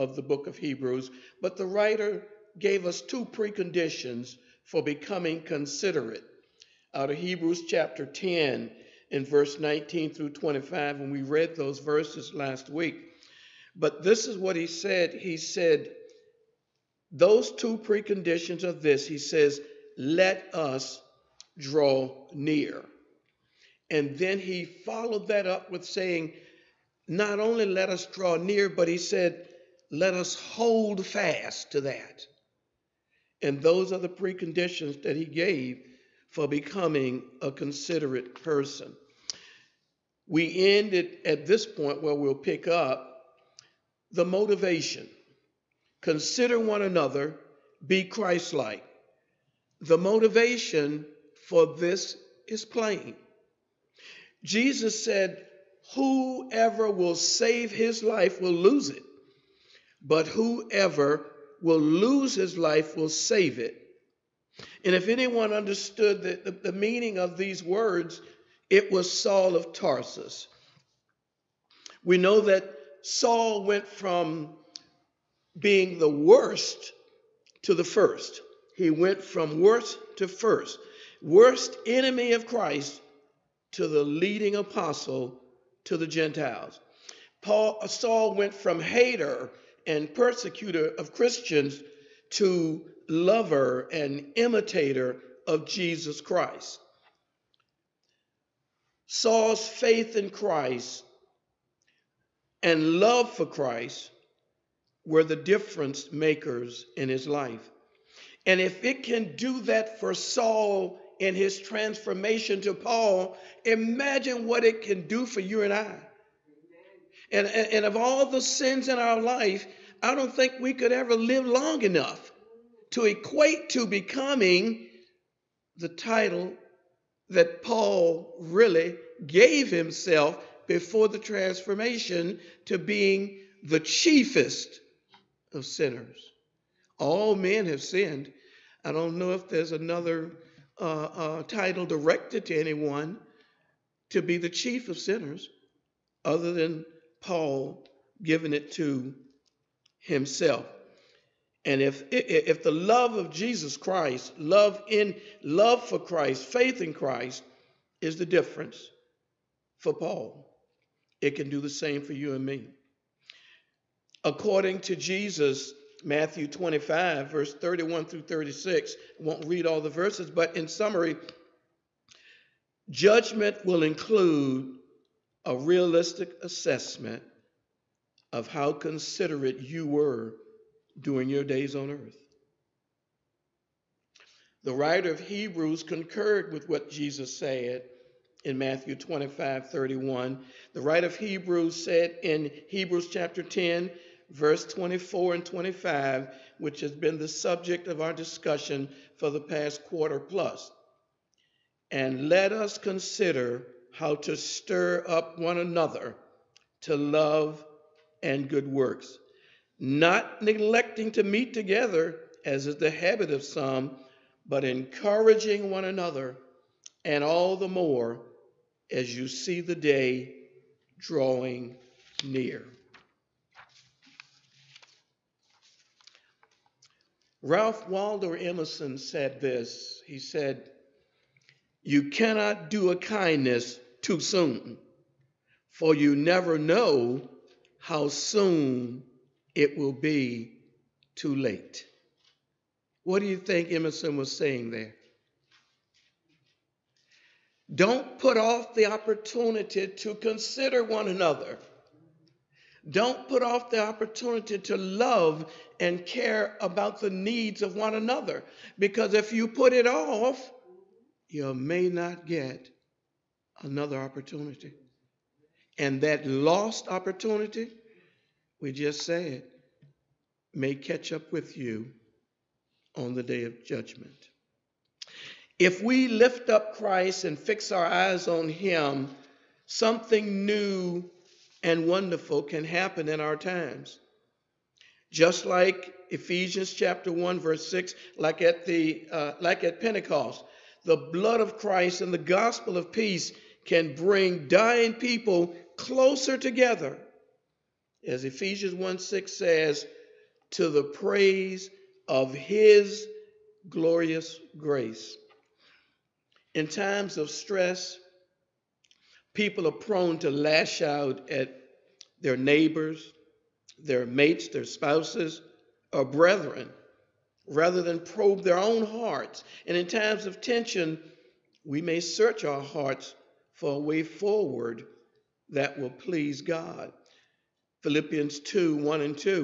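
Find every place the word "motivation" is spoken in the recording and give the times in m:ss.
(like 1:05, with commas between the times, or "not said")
0:44, 0:49.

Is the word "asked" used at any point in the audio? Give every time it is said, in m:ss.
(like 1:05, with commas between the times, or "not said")
not said.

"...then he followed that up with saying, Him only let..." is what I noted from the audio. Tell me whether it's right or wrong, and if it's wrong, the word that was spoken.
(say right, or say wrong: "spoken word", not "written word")
wrong: "Not", not "Him".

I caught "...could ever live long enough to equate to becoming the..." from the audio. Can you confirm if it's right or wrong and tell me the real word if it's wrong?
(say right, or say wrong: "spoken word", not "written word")
right.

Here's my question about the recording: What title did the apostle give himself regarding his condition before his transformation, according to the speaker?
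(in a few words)
chiefest of sinners.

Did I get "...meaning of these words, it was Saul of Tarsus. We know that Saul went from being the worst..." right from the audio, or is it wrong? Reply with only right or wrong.
right.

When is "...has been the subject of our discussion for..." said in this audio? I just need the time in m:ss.
3:16.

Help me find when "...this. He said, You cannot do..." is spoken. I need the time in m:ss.
3:49.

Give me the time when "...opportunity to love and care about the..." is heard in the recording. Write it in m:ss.
4:13.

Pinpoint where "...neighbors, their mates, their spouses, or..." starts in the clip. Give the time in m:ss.
5:12.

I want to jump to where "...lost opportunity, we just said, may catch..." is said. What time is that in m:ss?
4:26.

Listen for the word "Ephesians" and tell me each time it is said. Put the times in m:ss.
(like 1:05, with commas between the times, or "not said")
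4:46, 4:58.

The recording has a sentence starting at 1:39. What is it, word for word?
Saul's faith in Christ and love for Christ were the difference makers in his life.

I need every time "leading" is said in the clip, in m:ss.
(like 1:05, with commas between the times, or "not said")
1:24.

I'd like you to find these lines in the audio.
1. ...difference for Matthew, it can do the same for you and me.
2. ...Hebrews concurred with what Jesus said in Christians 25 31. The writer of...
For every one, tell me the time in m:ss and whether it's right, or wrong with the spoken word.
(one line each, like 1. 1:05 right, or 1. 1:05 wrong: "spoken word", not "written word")
1. 2:38 wrong: "Paul", not "Matthew"
2. 3:05 wrong: "Matthew", not "Christians".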